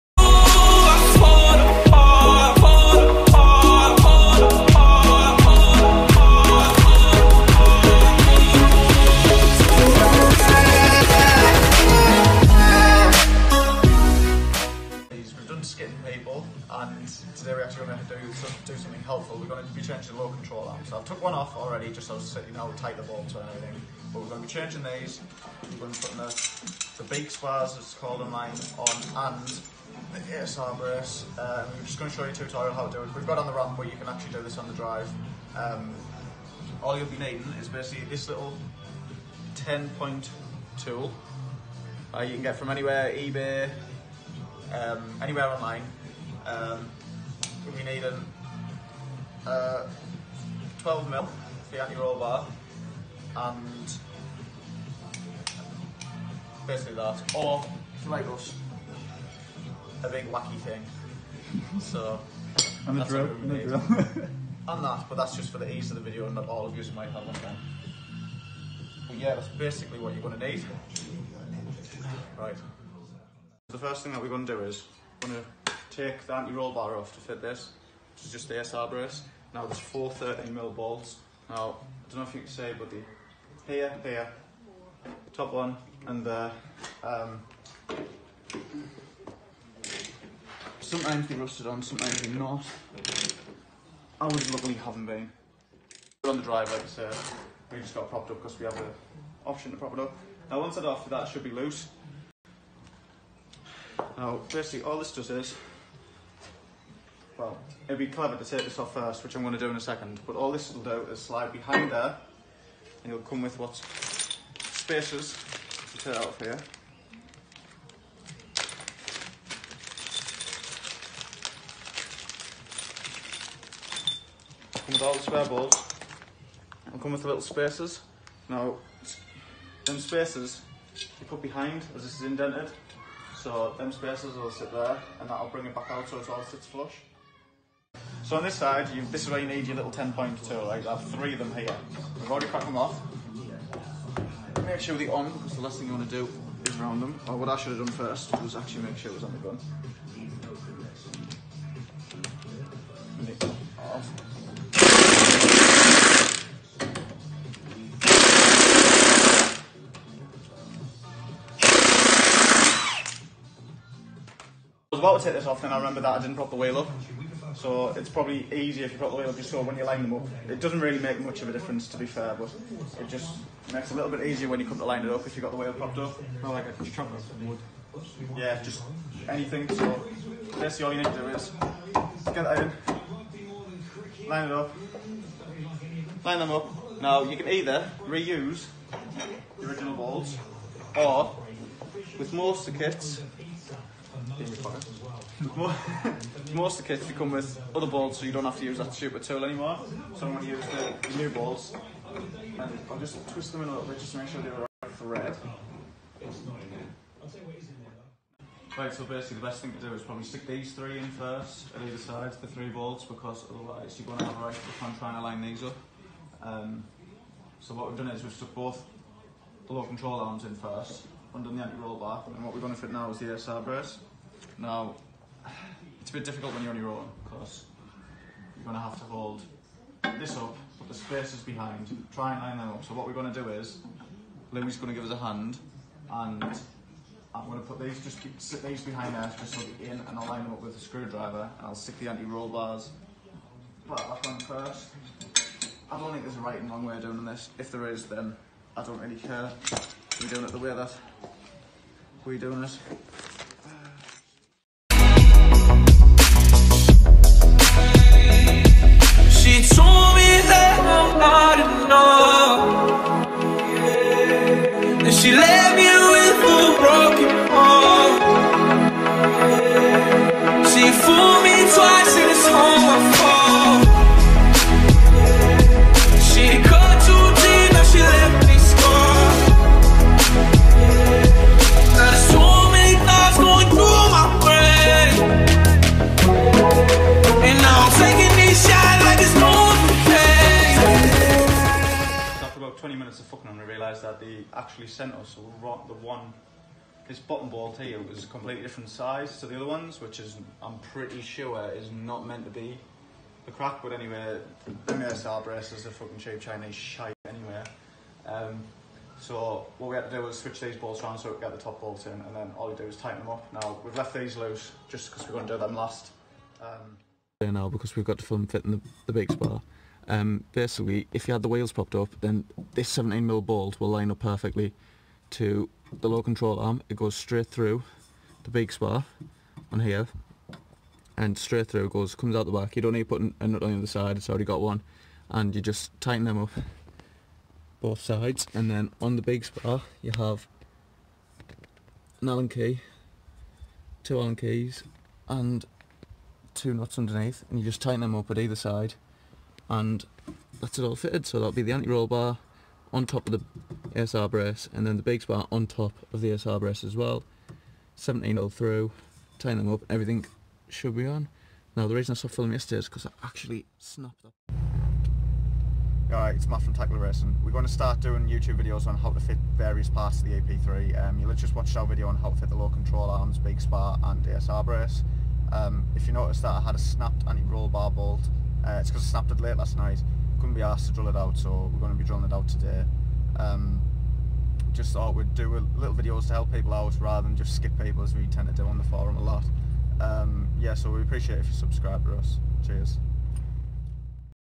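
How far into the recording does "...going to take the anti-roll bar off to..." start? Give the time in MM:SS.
01:15.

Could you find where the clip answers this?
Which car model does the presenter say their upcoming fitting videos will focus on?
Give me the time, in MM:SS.
06:10.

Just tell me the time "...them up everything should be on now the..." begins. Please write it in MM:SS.
05:59.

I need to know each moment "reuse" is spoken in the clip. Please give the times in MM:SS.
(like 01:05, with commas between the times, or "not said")
03:08.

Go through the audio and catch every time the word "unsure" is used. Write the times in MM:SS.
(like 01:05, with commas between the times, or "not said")
not said.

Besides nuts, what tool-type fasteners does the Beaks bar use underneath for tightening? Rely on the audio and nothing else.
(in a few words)
Allen key.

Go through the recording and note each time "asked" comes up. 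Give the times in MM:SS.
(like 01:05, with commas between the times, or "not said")
06:20.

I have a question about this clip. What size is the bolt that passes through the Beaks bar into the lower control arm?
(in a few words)
17mm.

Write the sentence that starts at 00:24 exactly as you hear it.
But we're going to be changing these.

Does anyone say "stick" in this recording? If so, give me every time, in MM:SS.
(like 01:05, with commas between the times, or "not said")
03:30, 04:01.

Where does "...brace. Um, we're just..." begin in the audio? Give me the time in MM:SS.
00:30.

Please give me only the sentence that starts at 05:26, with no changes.
It goes straight through the Beaks bar on here and straight through it goes, comes out the back.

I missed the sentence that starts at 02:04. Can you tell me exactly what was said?
Come with all the spare balls, and come with the little spaces.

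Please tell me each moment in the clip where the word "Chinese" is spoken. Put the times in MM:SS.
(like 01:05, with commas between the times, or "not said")
05:06.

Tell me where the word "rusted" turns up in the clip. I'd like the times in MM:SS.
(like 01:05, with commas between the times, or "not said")
01:31.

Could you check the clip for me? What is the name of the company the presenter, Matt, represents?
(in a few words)
Tactical Racing.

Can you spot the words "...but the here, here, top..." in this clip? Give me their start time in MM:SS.
01:22.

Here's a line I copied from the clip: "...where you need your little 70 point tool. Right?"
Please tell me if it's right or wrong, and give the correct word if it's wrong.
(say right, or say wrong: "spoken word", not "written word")
wrong: "10", not "70".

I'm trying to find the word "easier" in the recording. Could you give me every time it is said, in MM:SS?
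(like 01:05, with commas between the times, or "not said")
02:48, 02:54.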